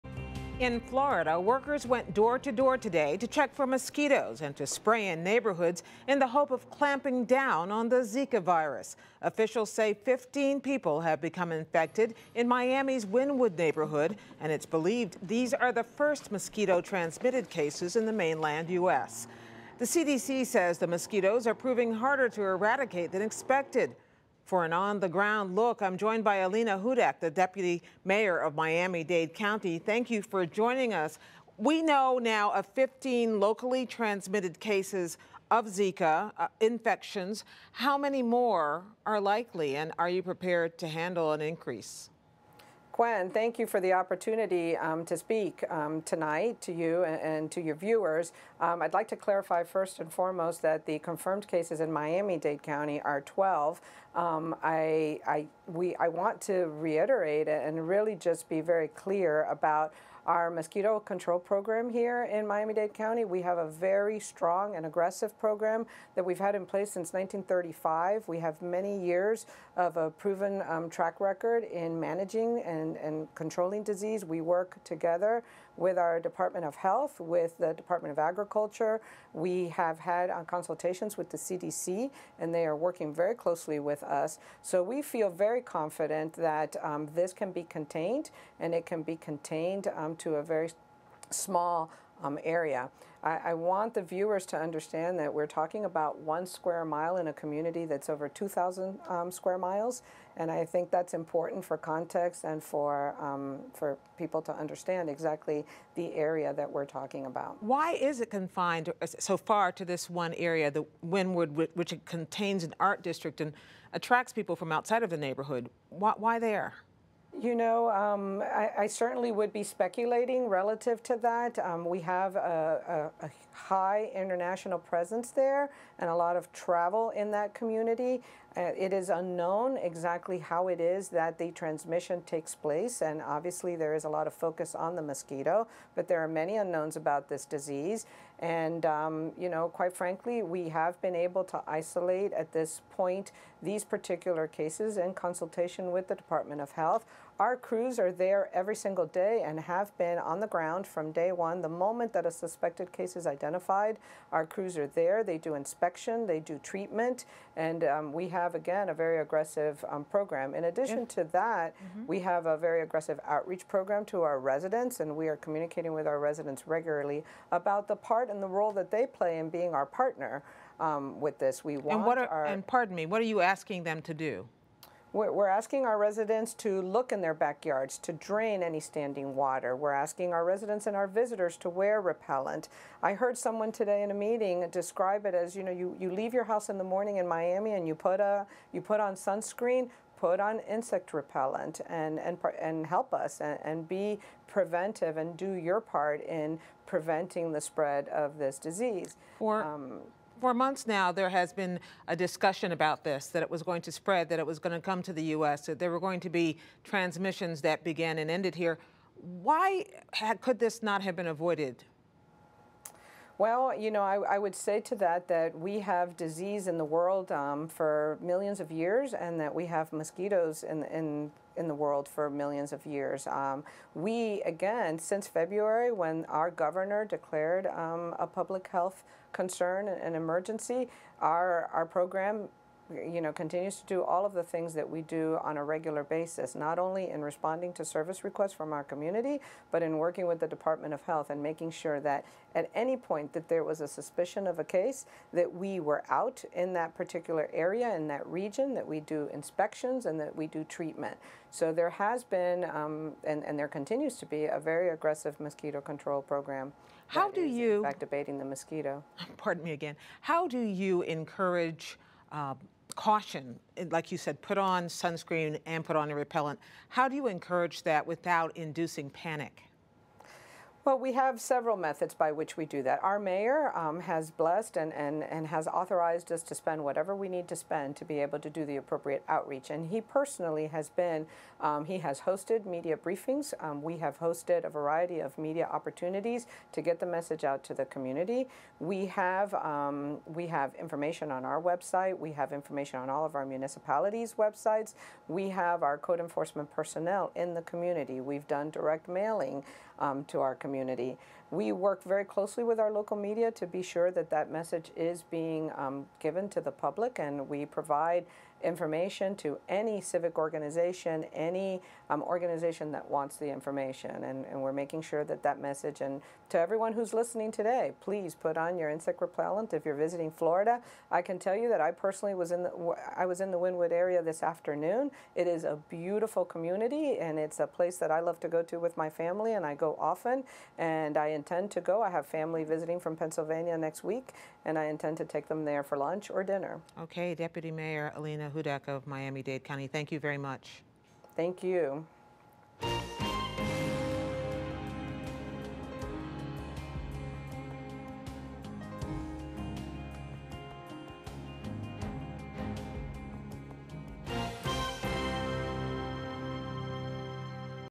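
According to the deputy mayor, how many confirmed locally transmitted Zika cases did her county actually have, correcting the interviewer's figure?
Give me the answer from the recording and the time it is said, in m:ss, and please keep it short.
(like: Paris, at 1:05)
12, at 0:53.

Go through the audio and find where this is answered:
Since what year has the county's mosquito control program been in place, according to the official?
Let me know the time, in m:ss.
1:07.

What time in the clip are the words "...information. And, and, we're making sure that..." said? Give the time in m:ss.
5:13.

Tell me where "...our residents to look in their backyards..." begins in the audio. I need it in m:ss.
2:55.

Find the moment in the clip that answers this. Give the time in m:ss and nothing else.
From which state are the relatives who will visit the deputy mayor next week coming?
5:33.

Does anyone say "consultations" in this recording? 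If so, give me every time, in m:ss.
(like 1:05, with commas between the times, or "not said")
1:20, 2:25.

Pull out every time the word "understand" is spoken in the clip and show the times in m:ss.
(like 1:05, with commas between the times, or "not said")
1:34, 1:44.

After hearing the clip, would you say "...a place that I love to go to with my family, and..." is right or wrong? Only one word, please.
right.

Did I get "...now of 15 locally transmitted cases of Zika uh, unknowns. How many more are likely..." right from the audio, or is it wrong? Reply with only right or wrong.
wrong.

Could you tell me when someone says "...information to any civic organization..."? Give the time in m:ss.
5:08.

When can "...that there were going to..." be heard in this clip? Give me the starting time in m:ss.
3:25.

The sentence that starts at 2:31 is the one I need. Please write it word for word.
The moment that a suspected case is identified, our crews are there.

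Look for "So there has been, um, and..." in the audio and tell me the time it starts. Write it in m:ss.
4:11.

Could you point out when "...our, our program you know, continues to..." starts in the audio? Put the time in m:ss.
3:51.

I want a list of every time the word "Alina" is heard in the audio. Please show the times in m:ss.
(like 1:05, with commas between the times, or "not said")
0:26, 5:38.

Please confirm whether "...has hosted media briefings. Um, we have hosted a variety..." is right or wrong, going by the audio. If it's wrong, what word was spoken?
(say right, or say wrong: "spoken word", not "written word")
right.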